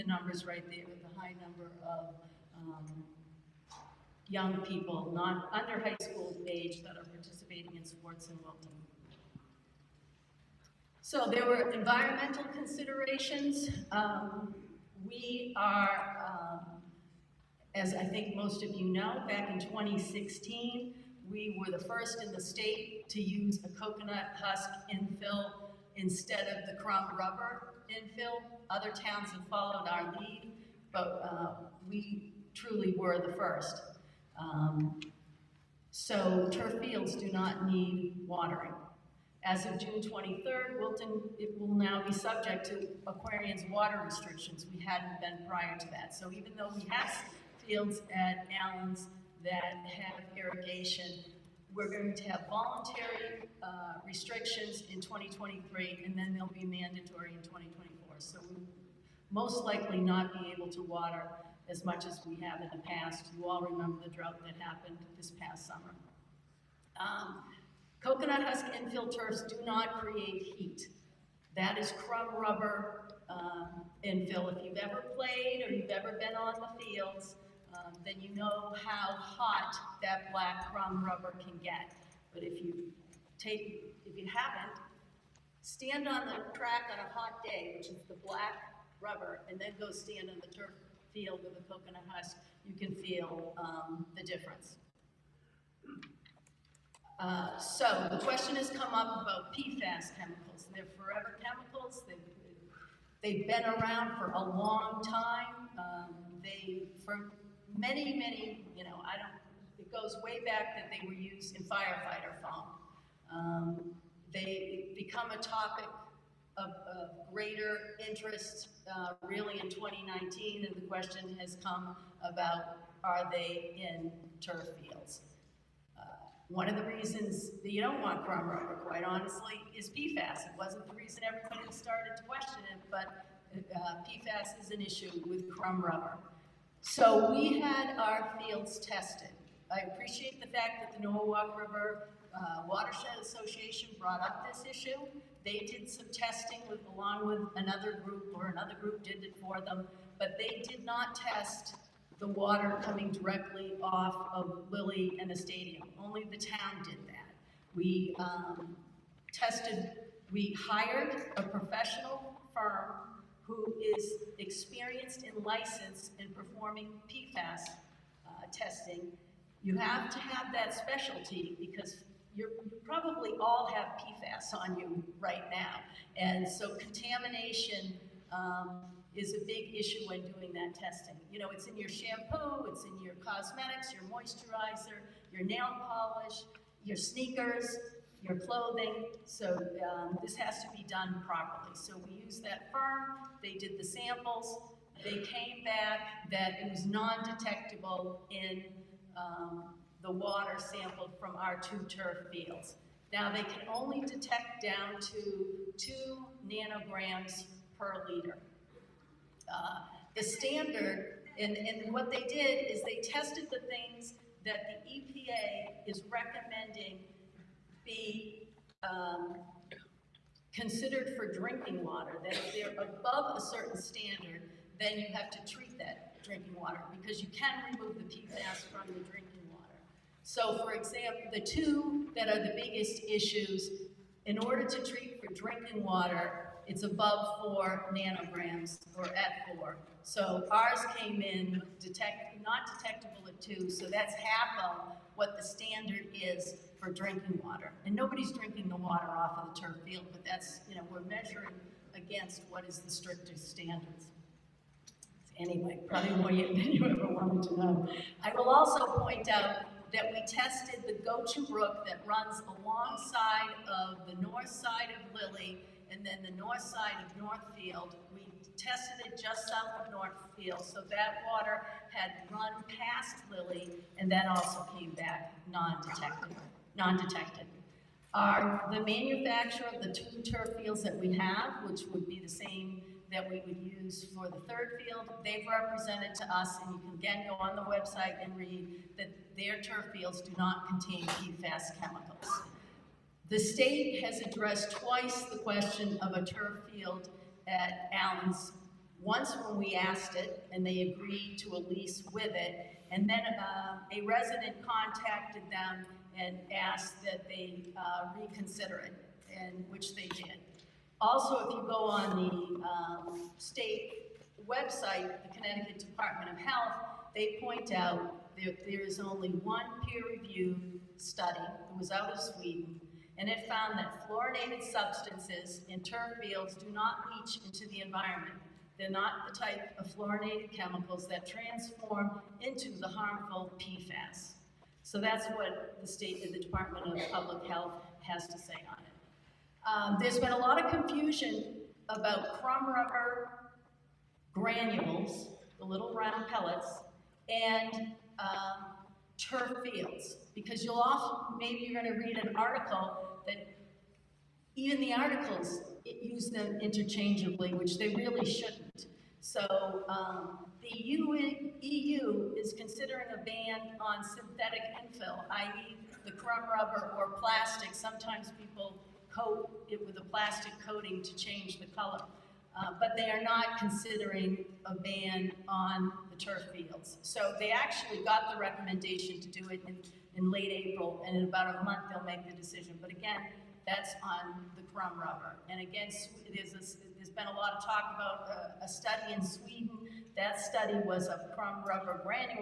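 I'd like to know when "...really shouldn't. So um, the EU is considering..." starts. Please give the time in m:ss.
5:57.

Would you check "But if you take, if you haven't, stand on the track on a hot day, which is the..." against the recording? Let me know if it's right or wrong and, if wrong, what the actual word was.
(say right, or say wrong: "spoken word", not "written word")
right.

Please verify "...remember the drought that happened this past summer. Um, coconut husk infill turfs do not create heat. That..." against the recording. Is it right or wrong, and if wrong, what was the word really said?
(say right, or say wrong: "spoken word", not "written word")
right.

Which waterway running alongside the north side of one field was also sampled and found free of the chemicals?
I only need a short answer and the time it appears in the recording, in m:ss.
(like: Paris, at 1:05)
Gochu Brook, at 4:20.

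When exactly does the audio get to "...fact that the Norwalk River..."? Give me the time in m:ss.
2:20.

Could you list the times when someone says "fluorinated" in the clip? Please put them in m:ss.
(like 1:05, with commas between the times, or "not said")
5:24, 5:29.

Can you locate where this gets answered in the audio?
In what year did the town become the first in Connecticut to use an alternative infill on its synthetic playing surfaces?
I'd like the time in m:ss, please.
0:19.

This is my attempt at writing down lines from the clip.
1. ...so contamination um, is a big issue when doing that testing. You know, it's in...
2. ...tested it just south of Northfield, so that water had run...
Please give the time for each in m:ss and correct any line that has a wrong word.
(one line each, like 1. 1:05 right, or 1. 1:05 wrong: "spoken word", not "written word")
1. 2:56 right
2. 4:28 right.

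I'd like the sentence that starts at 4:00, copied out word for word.
So ours came in detect, not detectable at two, so that's half of what the standard is for drinking water.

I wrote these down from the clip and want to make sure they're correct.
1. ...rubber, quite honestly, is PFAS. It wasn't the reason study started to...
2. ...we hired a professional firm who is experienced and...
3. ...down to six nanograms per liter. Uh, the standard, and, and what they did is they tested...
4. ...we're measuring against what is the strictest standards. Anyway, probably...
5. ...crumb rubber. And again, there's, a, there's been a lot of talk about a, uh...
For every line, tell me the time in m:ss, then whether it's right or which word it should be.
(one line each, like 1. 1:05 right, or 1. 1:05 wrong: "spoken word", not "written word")
1. 2:08 wrong: "everybody", not "study"
2. 2:40 right
3. 3:24 wrong: "two", not "six"
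4. 4:10 right
5. 6:24 right.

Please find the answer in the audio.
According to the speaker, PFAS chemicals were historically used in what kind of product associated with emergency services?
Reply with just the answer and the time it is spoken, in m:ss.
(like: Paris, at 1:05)
Firefighter foam, at 1:51.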